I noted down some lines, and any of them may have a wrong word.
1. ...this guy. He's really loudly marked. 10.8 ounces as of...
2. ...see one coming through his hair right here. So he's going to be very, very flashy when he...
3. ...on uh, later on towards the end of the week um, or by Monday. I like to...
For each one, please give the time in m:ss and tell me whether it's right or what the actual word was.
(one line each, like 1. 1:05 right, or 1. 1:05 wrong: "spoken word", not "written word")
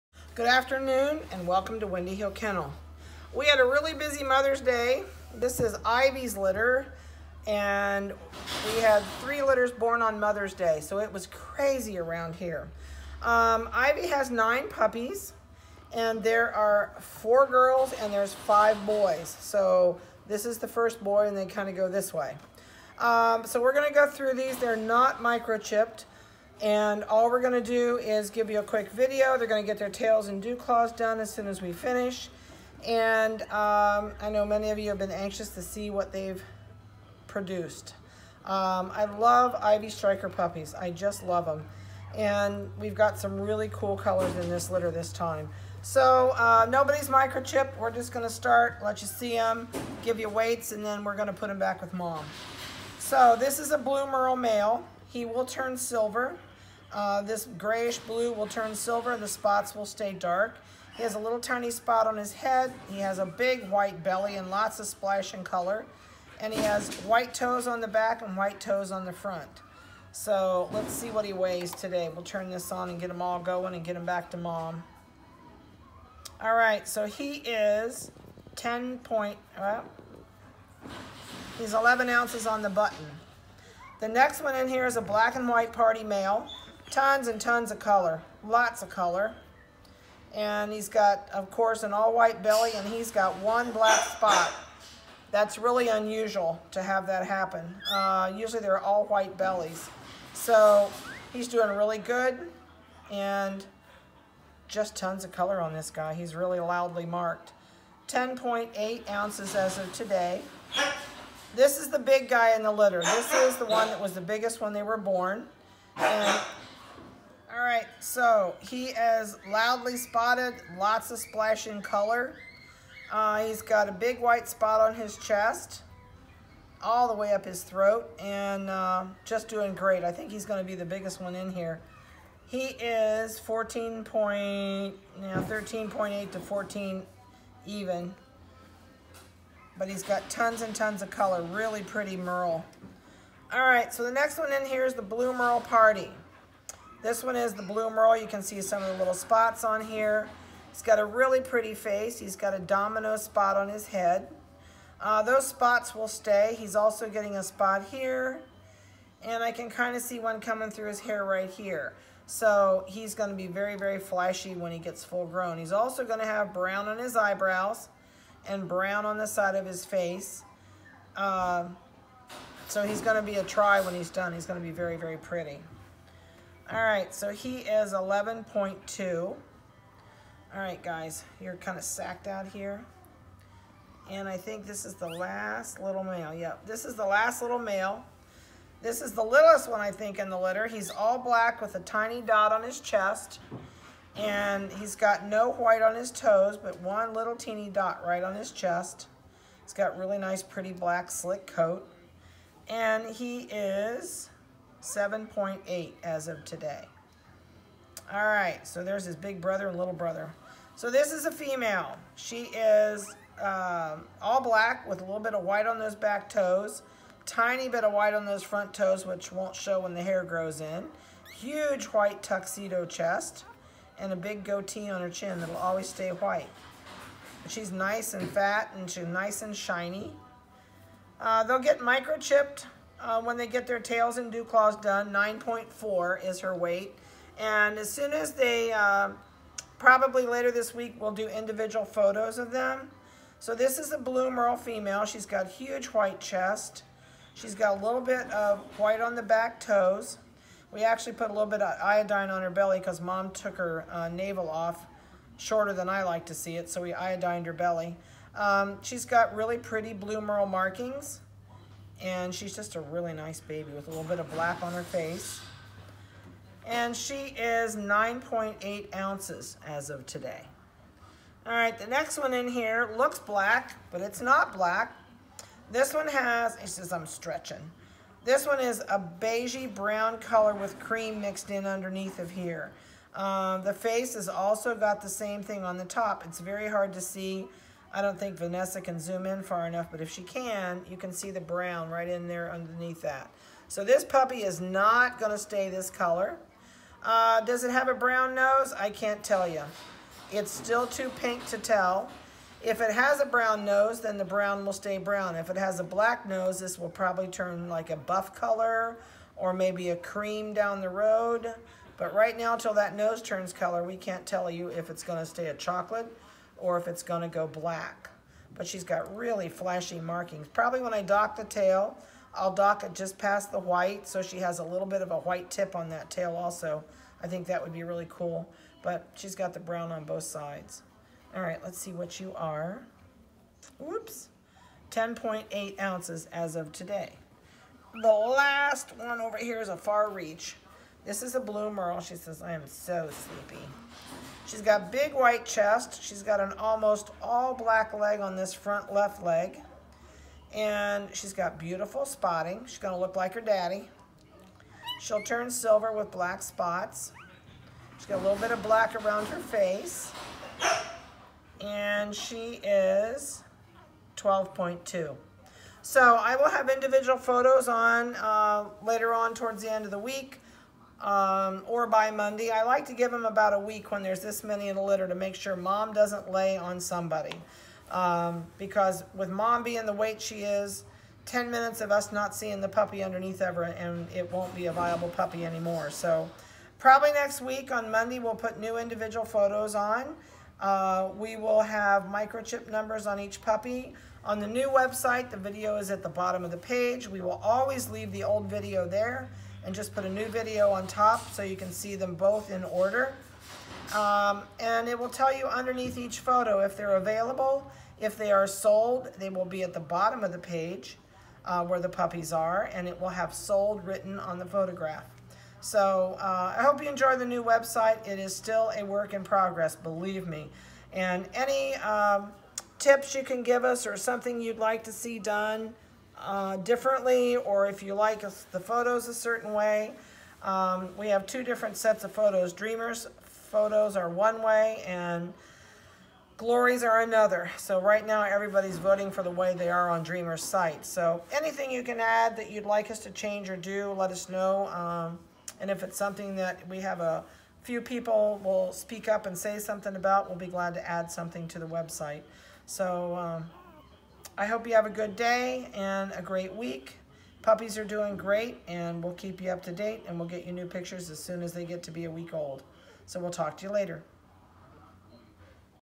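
1. 1:45 right
2. 2:40 right
3. 6:07 right.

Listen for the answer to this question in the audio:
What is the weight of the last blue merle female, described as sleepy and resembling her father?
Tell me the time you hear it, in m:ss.
6:04.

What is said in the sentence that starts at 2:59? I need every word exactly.
All right, guys, you're kind of sacked out here.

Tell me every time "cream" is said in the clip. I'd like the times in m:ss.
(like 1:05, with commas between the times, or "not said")
4:40, 5:09.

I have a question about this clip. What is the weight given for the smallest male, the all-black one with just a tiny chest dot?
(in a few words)
7.8.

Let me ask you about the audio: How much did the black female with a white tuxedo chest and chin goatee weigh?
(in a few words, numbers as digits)
9.4.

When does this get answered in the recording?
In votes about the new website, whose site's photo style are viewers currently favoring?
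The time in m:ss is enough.
7:20.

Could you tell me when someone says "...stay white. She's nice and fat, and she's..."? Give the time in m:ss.
3:45.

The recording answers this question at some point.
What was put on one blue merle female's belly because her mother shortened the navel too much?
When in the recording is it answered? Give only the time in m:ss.
4:11.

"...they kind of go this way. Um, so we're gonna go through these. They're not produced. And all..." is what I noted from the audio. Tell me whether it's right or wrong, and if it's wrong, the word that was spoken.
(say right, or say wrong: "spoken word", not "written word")
wrong: "microchipped", not "produced".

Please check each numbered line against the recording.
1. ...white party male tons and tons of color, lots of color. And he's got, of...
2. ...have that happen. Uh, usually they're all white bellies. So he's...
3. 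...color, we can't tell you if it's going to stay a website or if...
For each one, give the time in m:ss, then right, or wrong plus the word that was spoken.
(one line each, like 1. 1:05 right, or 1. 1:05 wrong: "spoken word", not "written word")
1. 1:25 right
2. 1:36 right
3. 5:13 wrong: "chocolate", not "website".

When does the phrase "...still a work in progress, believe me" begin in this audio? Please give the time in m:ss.
6:58.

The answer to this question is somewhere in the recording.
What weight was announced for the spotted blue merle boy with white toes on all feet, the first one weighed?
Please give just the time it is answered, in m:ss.
1:21.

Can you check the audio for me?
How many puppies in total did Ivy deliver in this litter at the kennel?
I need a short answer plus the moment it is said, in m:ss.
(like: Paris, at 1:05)
9, at 0:14.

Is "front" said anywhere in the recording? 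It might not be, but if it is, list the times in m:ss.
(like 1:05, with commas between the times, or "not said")
1:09, 3:38, 5:48.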